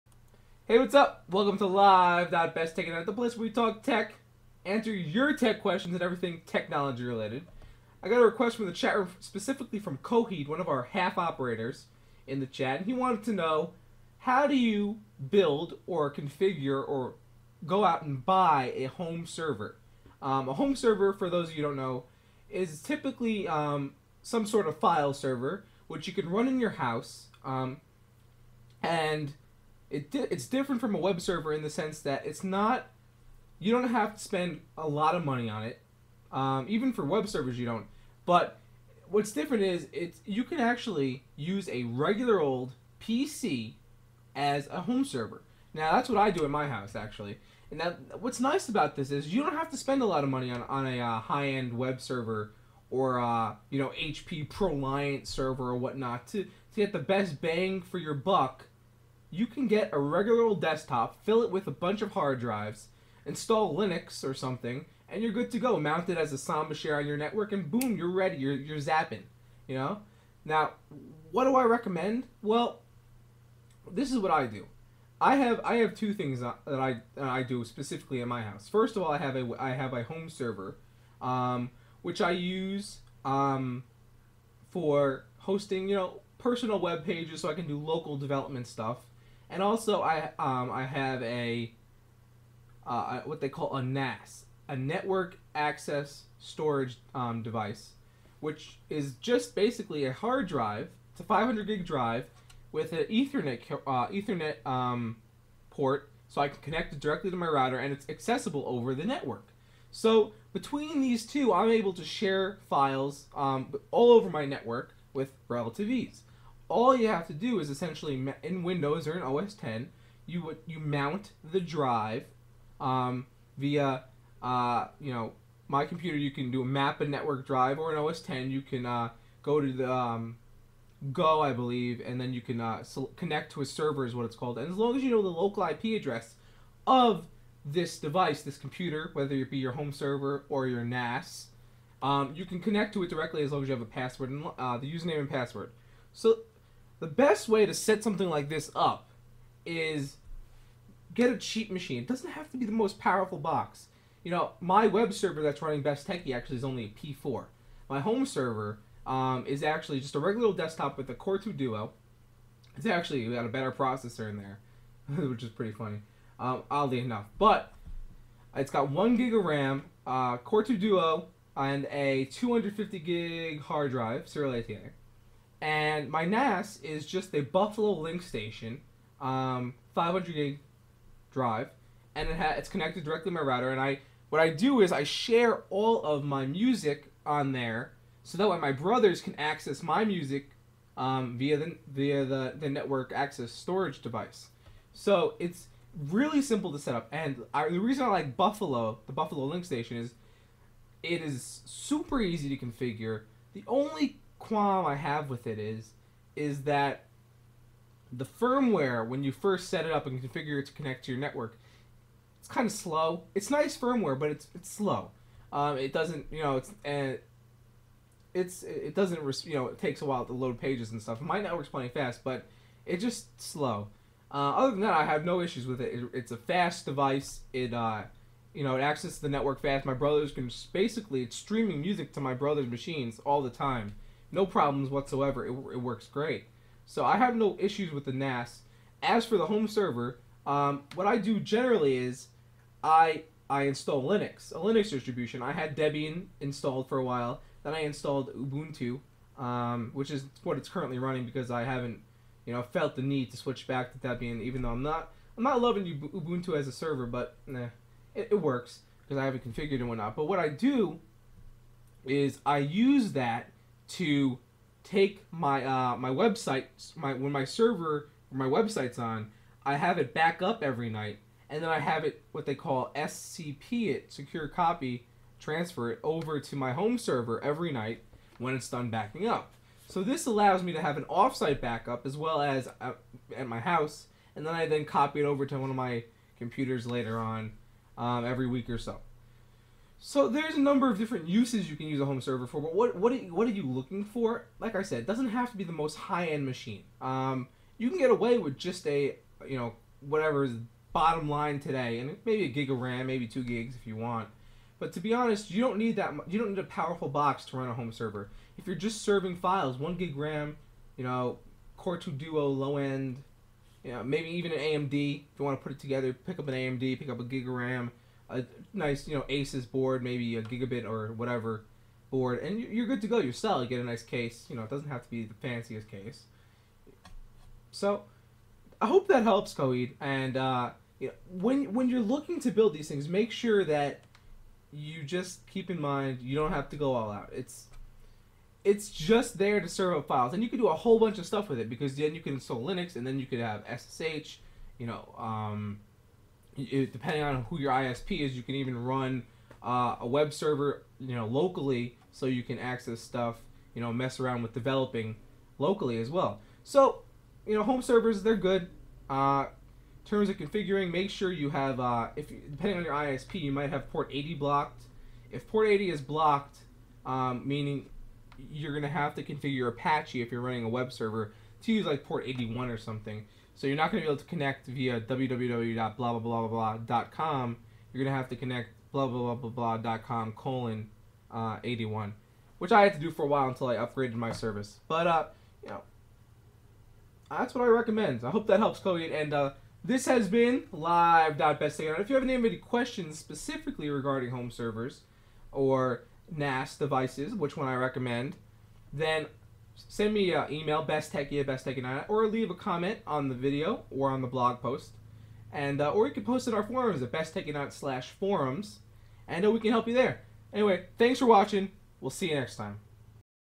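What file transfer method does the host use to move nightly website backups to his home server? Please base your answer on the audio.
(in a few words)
SCP.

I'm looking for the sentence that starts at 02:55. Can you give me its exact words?
And my NAS is just a Buffalo Link Station, um, 500 gig drive, and it ha- it's connected directly to my router.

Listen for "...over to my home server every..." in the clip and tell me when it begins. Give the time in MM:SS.
04:36.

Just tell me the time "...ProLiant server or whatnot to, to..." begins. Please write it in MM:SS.
00:54.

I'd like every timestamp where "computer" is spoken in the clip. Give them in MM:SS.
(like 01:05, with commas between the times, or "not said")
02:05, 02:18, 04:46.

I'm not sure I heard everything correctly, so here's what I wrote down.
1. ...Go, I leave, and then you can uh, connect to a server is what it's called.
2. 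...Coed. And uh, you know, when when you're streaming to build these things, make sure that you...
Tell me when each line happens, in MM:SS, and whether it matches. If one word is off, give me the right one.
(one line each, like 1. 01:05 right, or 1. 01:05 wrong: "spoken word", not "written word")
1. 02:11 wrong: "believe", not "leave"
2. 05:29 wrong: "looking", not "streaming".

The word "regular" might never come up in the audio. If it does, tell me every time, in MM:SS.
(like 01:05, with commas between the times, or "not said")
00:41, 00:59, 02:40.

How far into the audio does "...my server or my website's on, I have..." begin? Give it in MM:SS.
04:27.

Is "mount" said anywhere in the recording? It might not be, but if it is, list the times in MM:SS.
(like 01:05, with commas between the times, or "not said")
01:05, 02:00.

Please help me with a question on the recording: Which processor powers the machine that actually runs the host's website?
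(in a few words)
P4.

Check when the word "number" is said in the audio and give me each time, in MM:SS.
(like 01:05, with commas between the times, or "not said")
04:50.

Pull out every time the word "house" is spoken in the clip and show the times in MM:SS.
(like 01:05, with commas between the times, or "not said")
00:26, 00:46, 01:18, 04:43.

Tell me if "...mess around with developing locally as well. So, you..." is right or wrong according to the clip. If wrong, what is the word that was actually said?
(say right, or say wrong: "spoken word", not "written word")
right.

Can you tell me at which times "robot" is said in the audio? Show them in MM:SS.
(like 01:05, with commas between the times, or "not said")
not said.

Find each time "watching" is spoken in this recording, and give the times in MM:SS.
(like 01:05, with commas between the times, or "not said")
06:51.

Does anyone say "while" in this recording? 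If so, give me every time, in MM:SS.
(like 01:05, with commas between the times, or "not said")
03:40, 04:07, 06:23.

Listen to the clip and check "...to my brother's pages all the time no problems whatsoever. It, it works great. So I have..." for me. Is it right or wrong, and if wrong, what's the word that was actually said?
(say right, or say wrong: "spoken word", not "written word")
wrong: "machines", not "pages".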